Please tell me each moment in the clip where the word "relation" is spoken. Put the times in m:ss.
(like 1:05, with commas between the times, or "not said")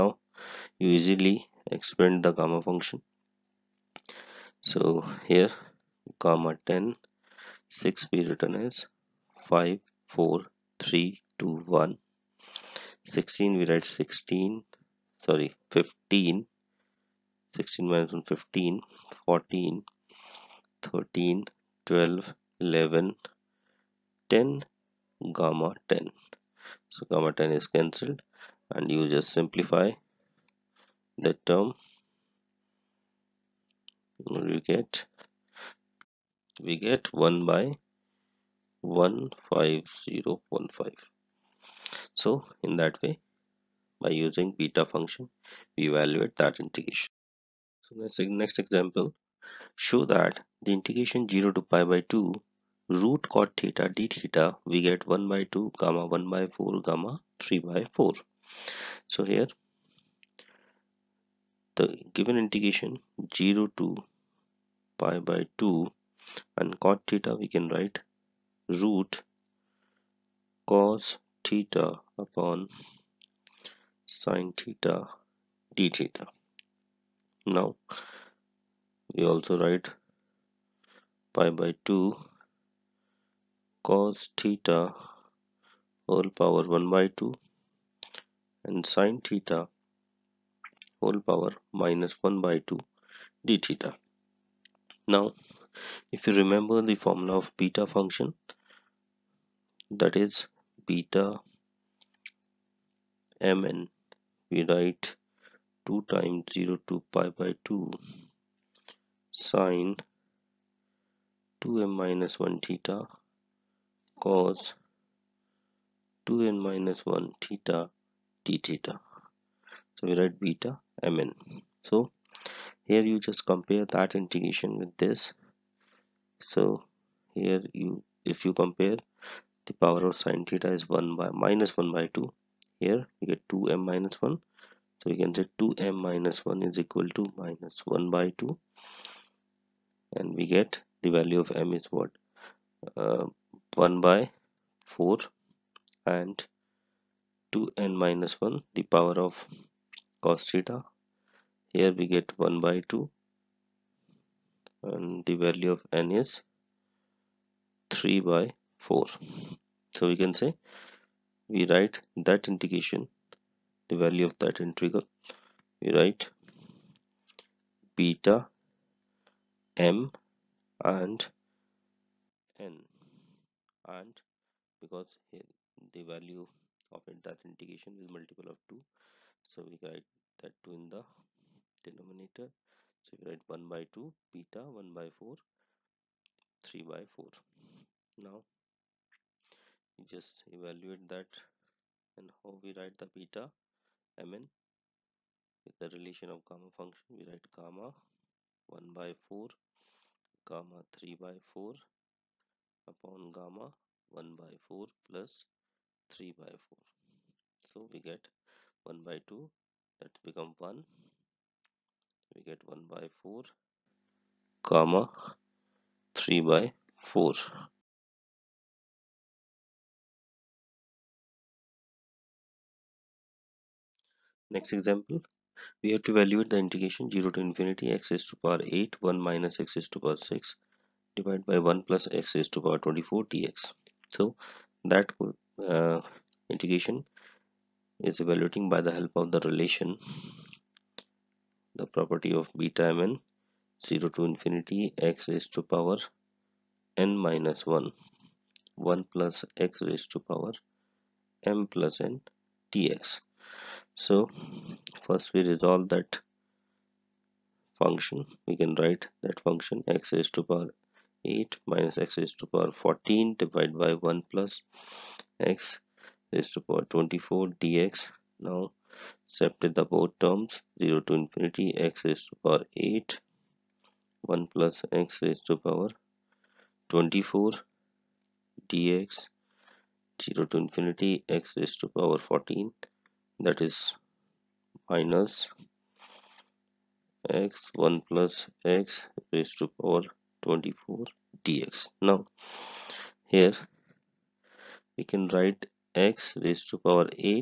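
3:15, 3:59.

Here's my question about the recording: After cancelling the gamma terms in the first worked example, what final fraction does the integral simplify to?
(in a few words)
1/15015.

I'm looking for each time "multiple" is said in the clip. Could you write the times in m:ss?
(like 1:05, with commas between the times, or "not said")
2:58.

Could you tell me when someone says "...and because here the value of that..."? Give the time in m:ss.
2:53.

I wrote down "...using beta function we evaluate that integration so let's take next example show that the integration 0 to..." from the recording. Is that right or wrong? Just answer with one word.
right.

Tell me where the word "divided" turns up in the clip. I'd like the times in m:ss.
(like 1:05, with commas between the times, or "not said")
3:51, 4:23.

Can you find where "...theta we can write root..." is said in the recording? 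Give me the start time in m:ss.
1:07.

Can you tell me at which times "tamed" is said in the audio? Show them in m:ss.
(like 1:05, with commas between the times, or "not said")
not said.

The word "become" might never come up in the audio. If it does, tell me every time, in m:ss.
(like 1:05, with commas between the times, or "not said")
3:30.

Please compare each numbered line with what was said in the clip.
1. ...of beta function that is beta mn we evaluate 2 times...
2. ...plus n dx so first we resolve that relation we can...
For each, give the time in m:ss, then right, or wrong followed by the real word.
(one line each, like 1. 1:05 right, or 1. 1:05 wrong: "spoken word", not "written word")
1. 1:37 wrong: "write", not "evaluate"
2. 4:11 wrong: "function", not "relation".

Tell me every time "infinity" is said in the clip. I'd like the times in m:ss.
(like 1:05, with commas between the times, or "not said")
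3:47, 4:04, 4:31, 4:40.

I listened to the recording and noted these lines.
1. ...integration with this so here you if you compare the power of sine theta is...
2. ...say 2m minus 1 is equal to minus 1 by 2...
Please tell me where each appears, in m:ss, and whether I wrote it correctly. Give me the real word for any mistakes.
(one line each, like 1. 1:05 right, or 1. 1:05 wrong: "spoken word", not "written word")
1. 2:04 right
2. 2:15 right.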